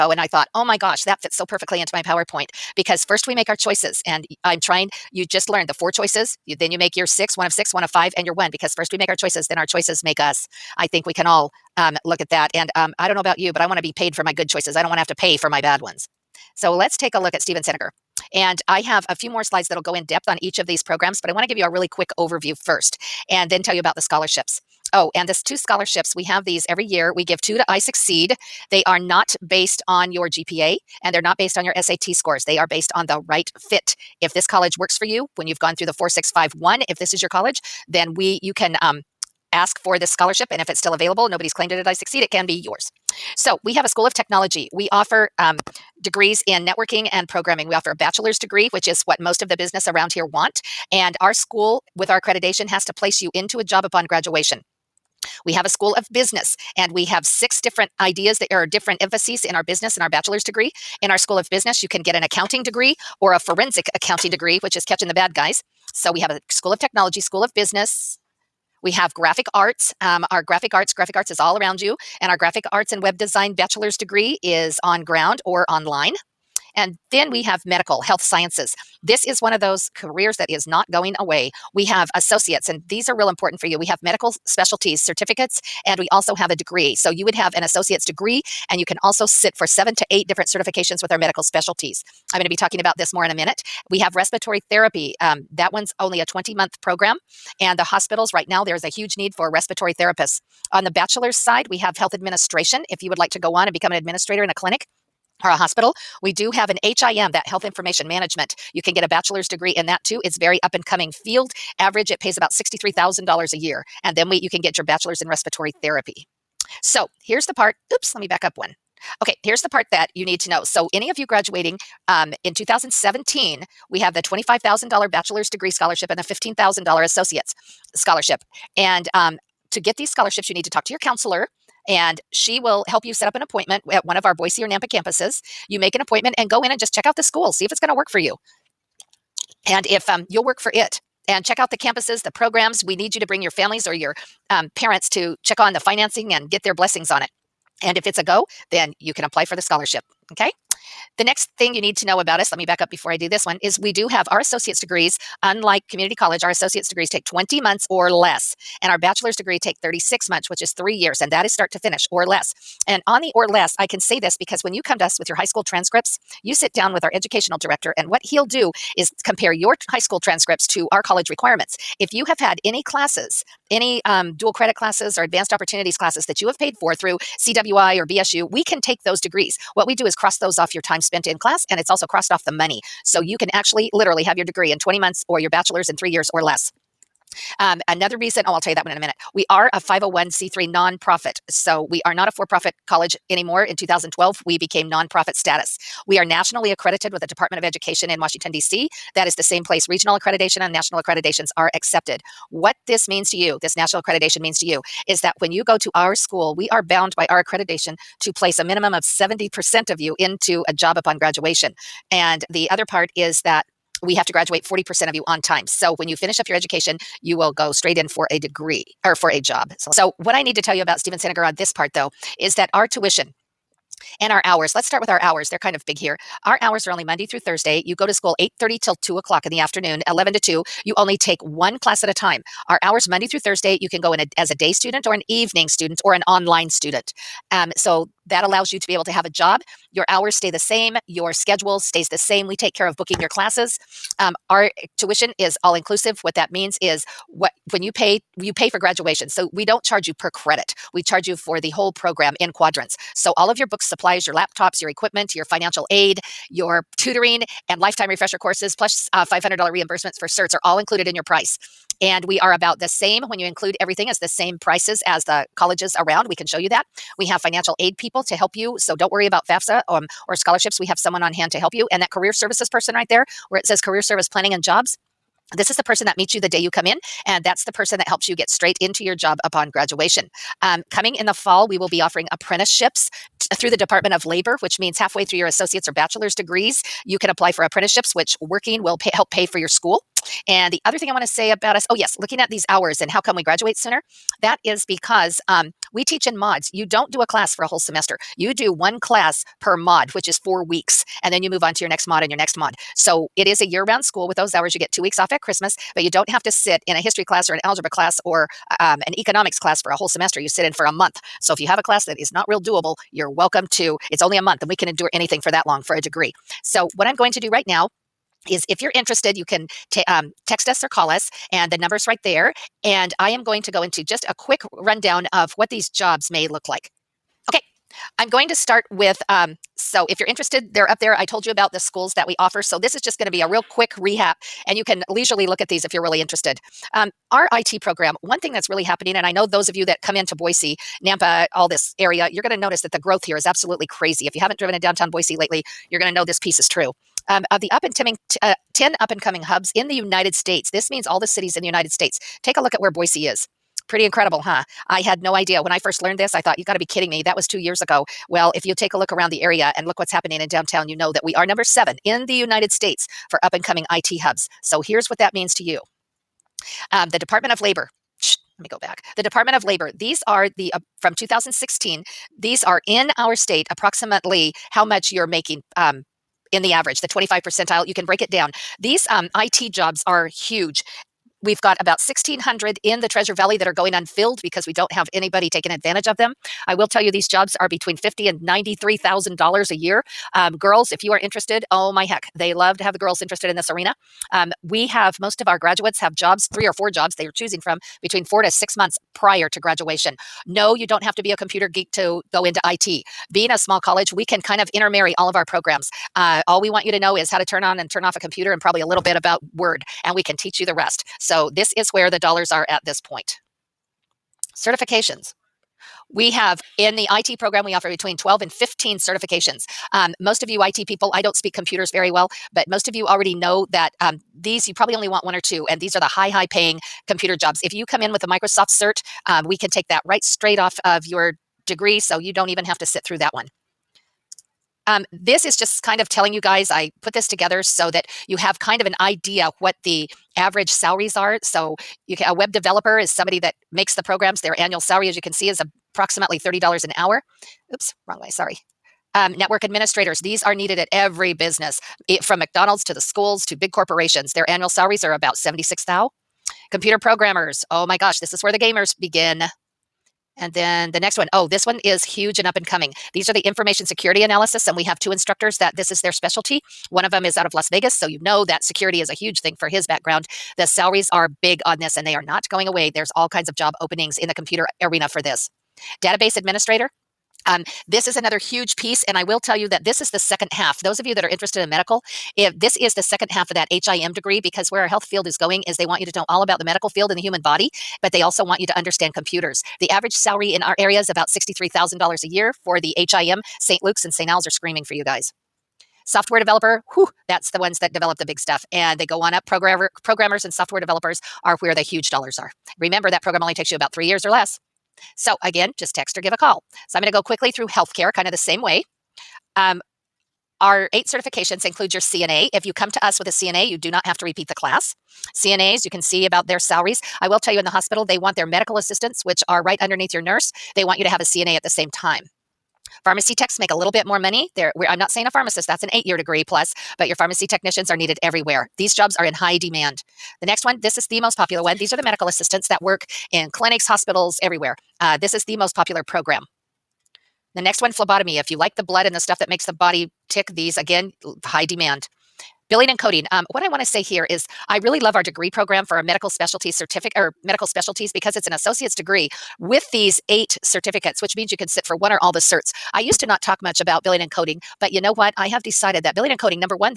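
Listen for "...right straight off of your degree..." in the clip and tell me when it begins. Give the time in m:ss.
7:10.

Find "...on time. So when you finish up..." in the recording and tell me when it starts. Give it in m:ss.
3:35.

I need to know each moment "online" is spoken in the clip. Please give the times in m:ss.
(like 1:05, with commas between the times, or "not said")
1:15, 3:56.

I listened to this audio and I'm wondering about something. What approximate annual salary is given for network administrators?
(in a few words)
76,000.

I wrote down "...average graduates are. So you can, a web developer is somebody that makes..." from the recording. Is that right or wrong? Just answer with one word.
wrong.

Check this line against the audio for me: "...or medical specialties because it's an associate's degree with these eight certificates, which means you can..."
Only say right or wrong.
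right.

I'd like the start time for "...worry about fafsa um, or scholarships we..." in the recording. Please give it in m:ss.
4:29.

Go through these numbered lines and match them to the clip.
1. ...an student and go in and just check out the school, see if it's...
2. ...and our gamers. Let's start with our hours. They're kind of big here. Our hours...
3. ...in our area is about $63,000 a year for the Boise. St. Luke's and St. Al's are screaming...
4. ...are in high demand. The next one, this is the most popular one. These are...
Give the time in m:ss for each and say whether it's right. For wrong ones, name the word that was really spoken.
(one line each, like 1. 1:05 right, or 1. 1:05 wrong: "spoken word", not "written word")
1. 2:15 wrong: "appointment", not "student"
2. 3:44 wrong: "hours", not "gamers"
3. 8:10 wrong: "HIM", not "Boise"
4. 8:49 right.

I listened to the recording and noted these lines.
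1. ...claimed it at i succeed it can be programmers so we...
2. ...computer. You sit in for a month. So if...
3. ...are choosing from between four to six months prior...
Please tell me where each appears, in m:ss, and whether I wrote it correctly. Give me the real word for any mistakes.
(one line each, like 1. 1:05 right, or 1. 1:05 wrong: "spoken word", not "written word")
1. 0:41 wrong: "yours", not "programmers"
2. 5:10 wrong: "semester", not "computer"
3. 6:37 right.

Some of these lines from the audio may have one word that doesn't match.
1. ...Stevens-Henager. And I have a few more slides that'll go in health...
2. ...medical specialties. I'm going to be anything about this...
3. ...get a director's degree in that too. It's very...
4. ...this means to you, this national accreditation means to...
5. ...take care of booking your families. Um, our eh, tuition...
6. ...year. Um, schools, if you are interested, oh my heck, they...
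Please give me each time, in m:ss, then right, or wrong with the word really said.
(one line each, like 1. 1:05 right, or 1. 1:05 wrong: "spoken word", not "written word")
1. 0:17 wrong: "depth", not "health"
2. 1:31 wrong: "talking", not "anything"
3. 1:48 wrong: "bachelor", not "director"
4. 3:22 right
5. 4:02 wrong: "classes", not "families"
6. 6:29 wrong: "girls", not "schools".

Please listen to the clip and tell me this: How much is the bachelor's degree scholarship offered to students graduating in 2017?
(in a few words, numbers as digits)
$25,000.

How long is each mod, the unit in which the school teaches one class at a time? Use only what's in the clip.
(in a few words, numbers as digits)
four weeks.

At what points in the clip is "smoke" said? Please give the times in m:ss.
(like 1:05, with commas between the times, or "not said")
not said.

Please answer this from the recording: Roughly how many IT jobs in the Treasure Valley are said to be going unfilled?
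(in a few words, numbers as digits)
1,600.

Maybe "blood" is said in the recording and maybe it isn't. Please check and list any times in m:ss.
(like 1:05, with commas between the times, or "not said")
8:58.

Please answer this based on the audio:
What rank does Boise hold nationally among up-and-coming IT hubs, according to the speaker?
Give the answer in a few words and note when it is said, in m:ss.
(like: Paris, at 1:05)
number 7, at 6:01.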